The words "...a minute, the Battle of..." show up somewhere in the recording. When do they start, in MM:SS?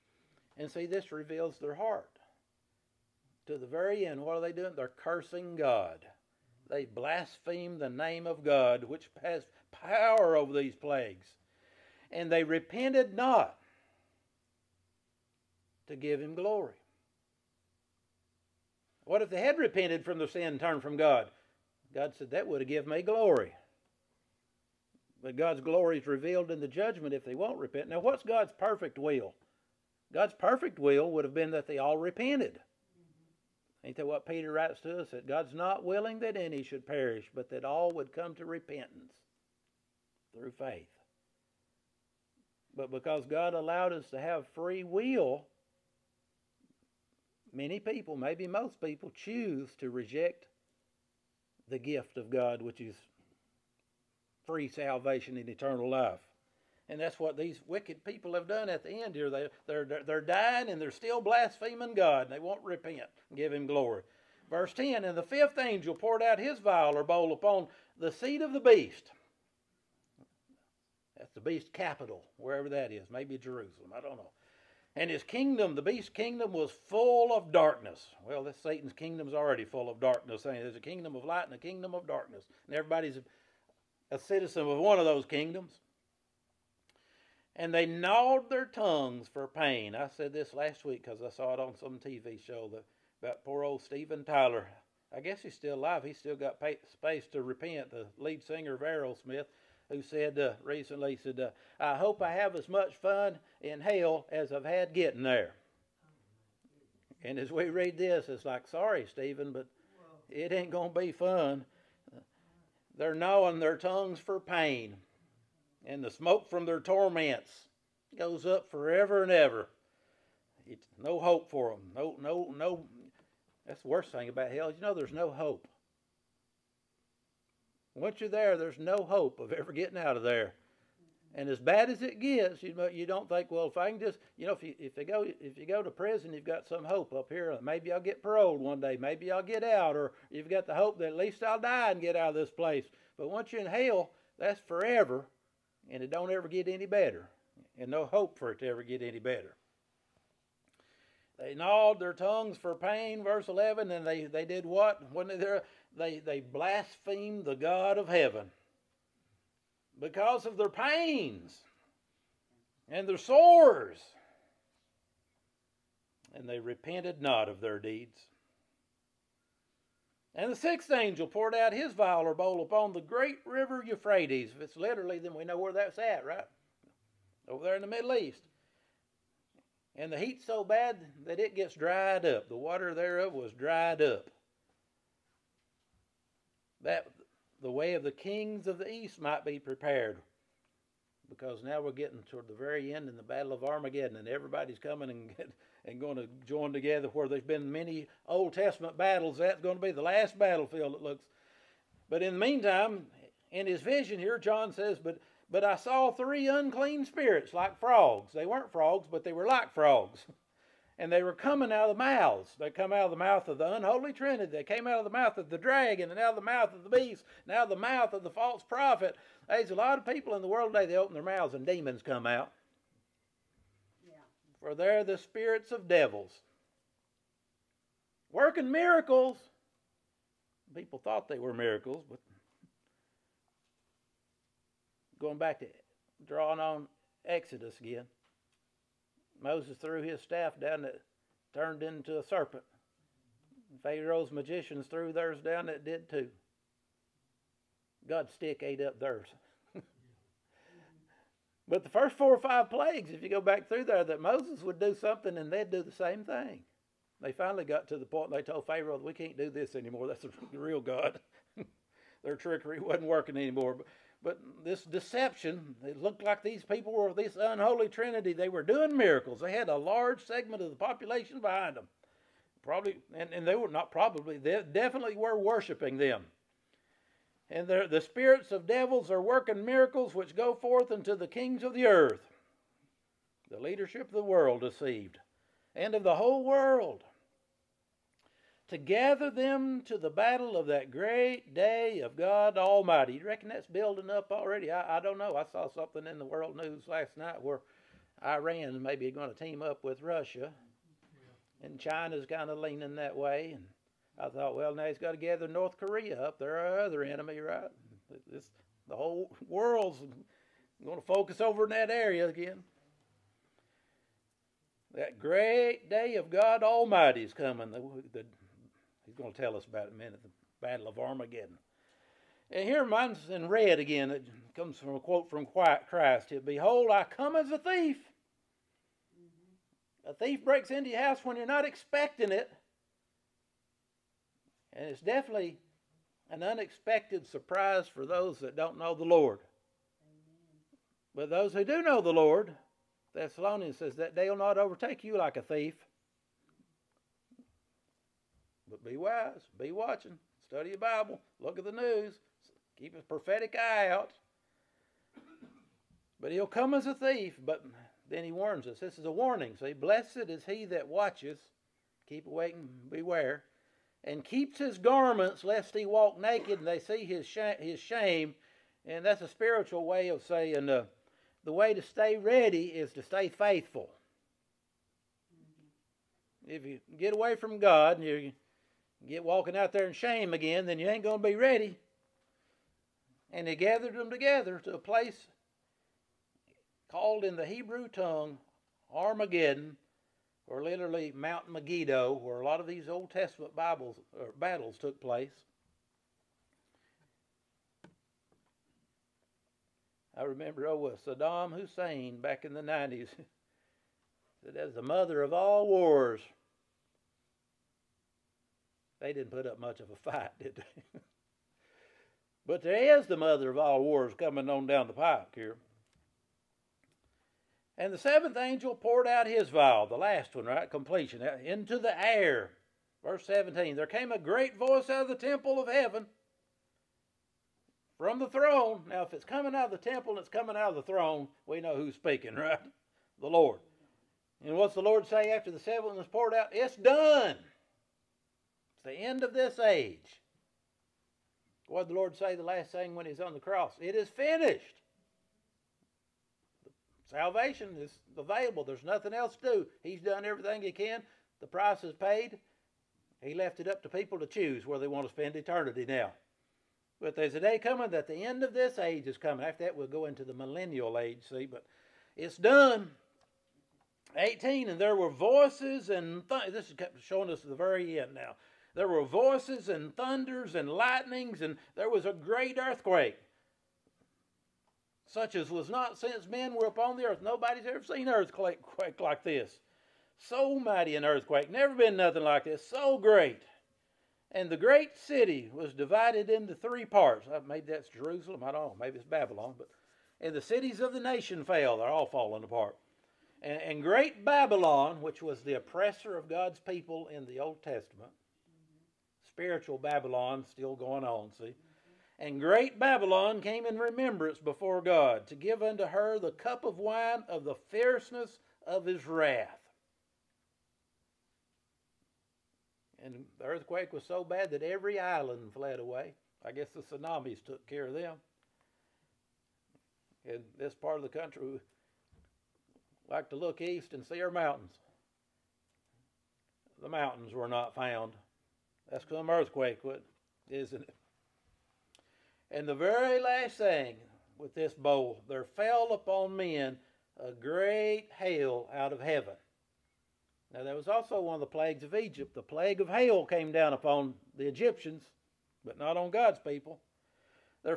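05:19.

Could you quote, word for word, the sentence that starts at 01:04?
Verse 10, And the fifth angel poured out his vial or bowl upon the seat of the beast.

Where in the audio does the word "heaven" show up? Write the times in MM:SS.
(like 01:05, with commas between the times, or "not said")
02:38, 07:05, 08:59.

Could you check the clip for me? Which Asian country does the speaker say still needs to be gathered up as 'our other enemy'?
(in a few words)
North Korea.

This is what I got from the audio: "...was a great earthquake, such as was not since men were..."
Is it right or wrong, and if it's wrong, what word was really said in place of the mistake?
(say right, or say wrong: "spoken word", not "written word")
right.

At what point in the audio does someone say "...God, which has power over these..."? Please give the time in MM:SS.
00:08.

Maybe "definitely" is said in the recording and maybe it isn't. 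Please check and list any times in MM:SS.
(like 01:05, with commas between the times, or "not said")
04:34, 05:34.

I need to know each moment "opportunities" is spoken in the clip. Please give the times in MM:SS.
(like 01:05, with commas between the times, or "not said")
not said.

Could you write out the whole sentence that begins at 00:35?
That God's not willing that any should perish, but that all would come to repentance through faith.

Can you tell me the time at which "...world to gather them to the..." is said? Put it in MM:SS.
04:46.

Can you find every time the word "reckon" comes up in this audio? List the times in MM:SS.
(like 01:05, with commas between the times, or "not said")
04:53.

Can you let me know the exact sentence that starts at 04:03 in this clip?
Pharaoh's magicians threw theirs down that did too.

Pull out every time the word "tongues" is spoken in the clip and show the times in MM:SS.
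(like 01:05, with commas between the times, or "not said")
01:28, 01:53, 02:32, 06:27.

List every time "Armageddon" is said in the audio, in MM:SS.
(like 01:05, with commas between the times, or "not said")
03:13, 05:20, 06:28.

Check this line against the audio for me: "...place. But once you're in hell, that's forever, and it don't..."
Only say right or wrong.
right.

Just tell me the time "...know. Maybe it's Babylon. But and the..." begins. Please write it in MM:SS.
08:08.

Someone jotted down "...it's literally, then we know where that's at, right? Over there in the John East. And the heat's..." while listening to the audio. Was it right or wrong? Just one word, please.
wrong.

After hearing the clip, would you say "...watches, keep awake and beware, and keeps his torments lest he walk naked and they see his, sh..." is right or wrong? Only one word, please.
wrong.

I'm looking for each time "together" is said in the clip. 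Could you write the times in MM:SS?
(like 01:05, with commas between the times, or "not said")
03:16, 06:24.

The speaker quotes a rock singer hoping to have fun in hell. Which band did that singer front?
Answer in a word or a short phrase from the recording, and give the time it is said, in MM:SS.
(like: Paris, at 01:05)
Aerosmith, at 01:38.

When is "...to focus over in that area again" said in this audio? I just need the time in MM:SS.
05:10.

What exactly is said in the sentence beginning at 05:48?
But be wise, be watching, study your Bible, look at the news, keep a prophetic eye out.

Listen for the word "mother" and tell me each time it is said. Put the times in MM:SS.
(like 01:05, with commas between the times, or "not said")
06:44, 06:53.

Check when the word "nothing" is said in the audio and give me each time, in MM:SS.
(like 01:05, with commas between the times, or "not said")
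07:28, 08:01.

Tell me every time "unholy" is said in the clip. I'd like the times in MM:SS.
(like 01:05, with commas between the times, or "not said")
03:33, 04:27.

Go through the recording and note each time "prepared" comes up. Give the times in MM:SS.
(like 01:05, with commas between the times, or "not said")
03:09.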